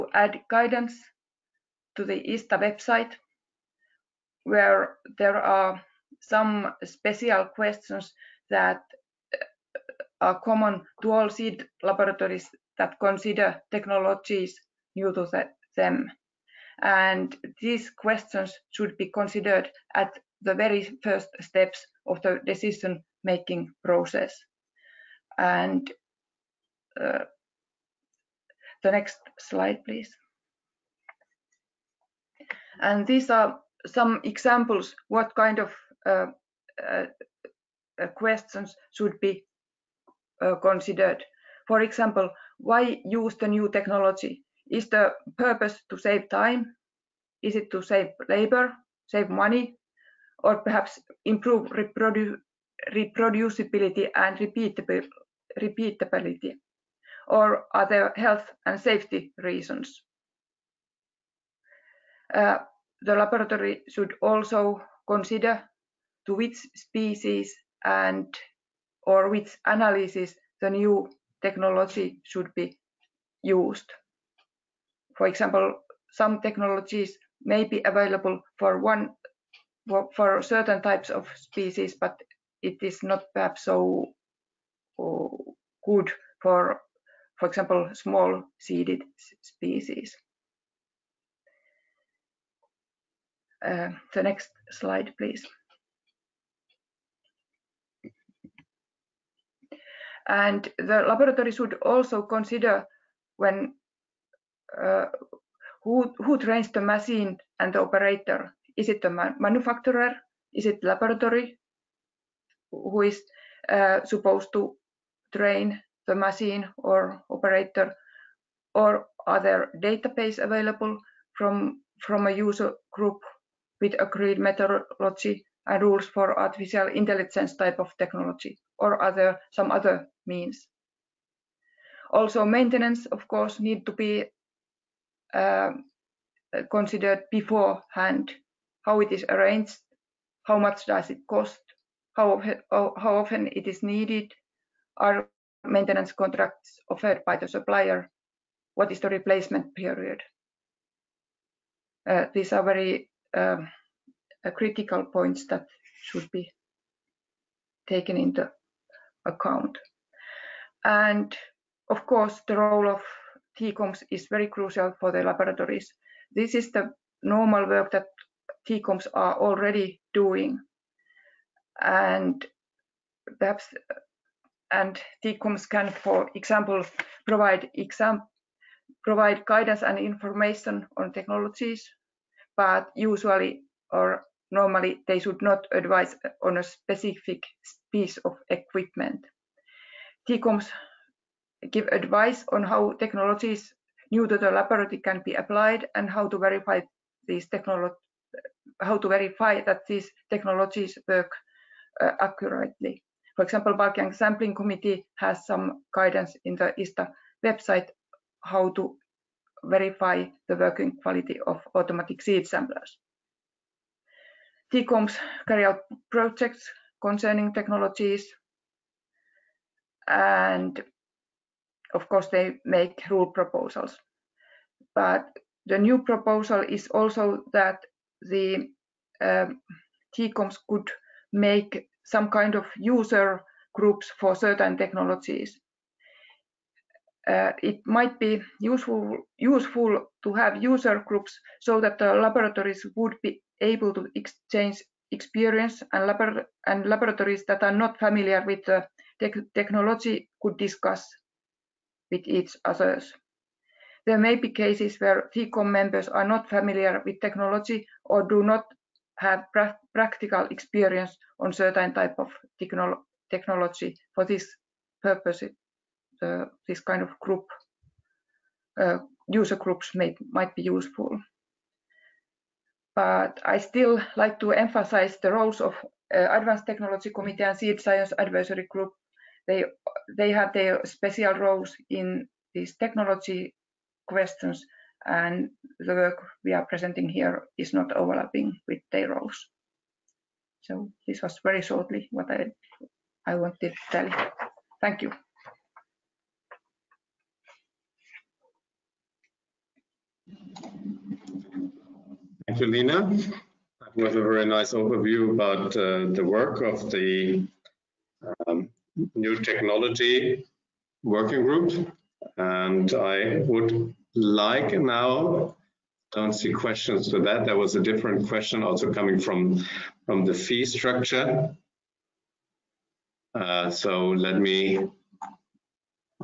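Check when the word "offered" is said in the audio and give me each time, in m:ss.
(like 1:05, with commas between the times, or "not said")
2:26.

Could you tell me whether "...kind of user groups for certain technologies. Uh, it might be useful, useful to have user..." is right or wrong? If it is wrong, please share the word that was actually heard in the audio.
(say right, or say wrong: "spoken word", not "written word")
right.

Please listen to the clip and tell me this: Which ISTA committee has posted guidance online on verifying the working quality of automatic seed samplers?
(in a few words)
Bulking Sampling Committee.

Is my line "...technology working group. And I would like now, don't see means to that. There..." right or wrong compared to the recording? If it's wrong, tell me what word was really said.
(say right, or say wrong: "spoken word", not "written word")
wrong: "questions", not "means".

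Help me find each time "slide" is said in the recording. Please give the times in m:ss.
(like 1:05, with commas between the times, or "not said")
0:29, 1:34.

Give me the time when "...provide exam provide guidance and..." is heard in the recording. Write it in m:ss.
2:57.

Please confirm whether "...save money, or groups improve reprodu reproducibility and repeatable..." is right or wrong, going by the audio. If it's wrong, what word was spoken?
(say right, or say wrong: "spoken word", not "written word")
wrong: "perhaps", not "groups".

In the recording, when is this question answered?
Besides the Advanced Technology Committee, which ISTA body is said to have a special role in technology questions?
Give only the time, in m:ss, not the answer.
4:37.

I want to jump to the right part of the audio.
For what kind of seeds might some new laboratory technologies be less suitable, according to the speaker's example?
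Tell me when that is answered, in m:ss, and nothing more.
1:27.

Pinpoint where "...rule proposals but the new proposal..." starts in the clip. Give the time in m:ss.
3:43.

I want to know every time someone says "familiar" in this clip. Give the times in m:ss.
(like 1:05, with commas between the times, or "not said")
4:07, 4:16.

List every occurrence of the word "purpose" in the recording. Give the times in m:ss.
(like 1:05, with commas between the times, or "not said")
0:45, 4:25.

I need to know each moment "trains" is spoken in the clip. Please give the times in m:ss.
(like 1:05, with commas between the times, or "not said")
1:46, 1:55.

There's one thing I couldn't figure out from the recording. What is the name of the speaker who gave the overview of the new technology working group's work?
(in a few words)
Lina.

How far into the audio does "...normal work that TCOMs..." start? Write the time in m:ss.
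2:47.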